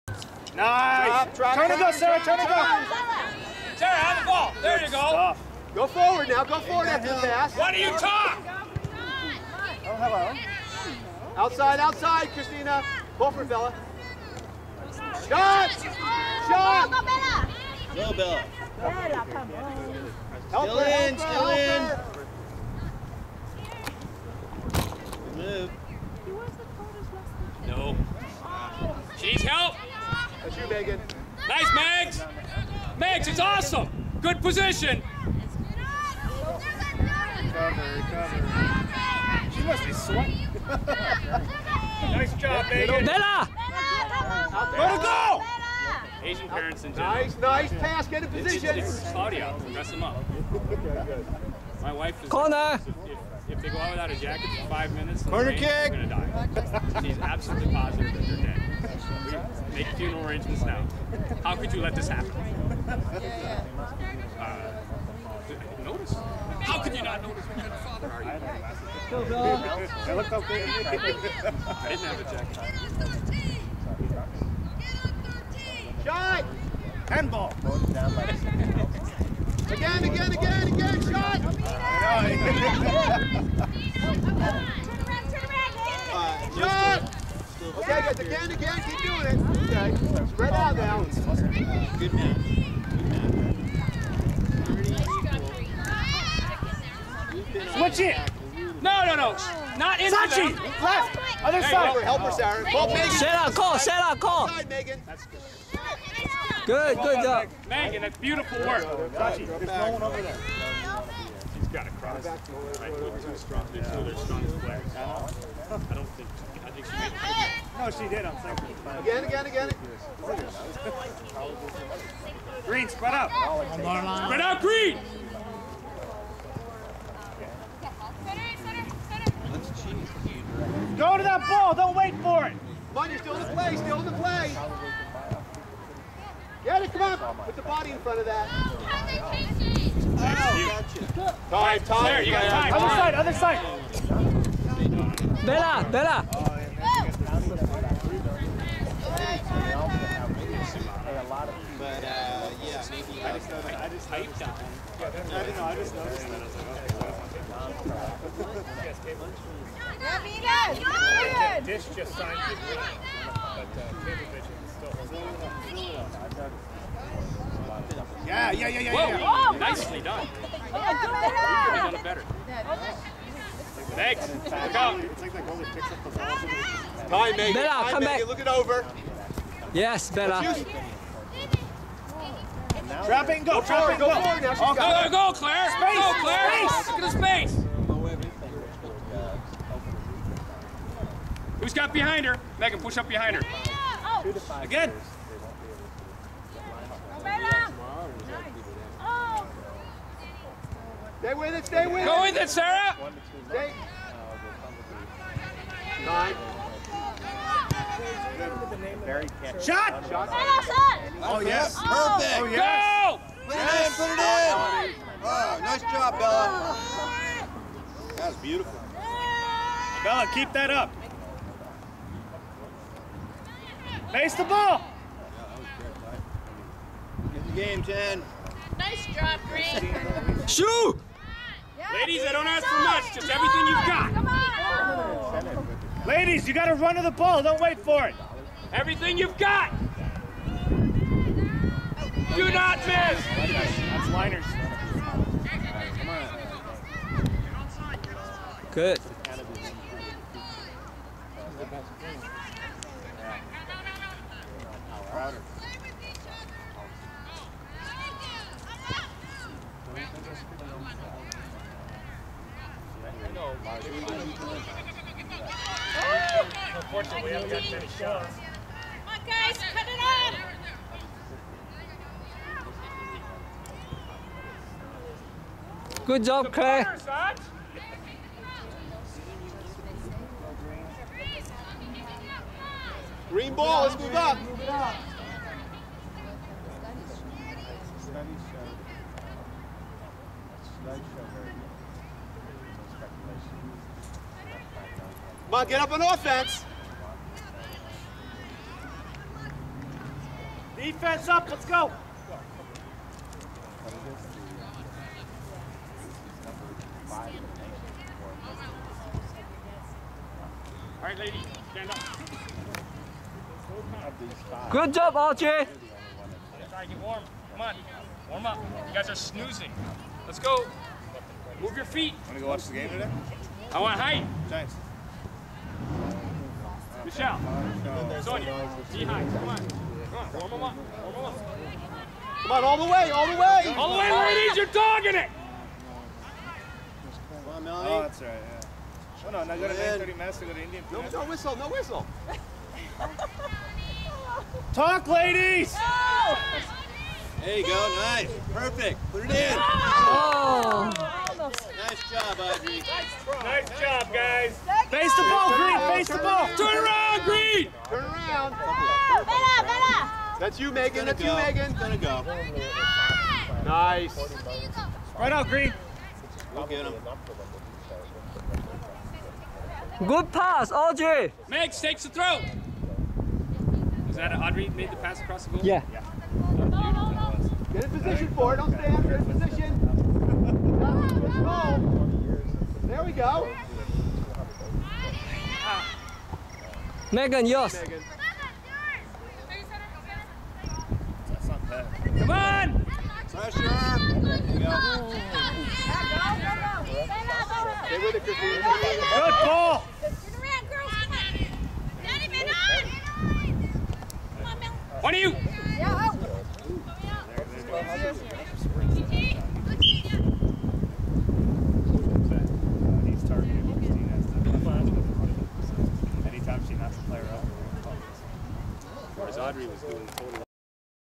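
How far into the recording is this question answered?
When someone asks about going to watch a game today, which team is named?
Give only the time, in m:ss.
5:24.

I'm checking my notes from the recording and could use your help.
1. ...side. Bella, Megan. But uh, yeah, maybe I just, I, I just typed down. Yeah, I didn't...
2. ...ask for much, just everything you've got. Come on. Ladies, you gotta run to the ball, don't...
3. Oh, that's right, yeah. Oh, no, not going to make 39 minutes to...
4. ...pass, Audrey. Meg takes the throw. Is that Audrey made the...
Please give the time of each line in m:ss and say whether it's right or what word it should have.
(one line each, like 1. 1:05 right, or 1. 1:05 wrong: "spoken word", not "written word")
1. 2:24 wrong: "Bella", not "Megan"
2. 3:52 right
3. 5:37 wrong: "30", not "39"
4. 6:10 right.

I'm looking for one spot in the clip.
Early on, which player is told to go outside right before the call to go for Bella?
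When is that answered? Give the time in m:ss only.
0:12.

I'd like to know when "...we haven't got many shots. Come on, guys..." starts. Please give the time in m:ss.
4:27.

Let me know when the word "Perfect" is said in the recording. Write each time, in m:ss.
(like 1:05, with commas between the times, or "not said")
3:31, 5:48.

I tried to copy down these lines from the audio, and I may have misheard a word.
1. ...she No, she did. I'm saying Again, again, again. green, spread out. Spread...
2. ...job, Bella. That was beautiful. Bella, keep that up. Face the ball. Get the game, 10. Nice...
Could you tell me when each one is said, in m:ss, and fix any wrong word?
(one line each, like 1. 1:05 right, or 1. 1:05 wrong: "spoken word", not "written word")
1. 1:56 right
2. 3:35 right.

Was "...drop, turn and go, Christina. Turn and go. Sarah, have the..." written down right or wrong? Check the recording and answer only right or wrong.
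wrong.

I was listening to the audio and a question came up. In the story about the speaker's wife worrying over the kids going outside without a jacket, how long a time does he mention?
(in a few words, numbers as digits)
5 minutes.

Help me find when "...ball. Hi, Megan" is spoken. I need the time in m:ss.
2:56.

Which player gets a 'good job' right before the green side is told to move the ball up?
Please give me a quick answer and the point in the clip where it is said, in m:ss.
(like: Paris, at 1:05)
Clay, at 4:36.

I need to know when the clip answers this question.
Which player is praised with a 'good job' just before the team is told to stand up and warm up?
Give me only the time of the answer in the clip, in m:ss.
5:15.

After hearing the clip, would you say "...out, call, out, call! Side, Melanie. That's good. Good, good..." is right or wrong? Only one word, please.
wrong.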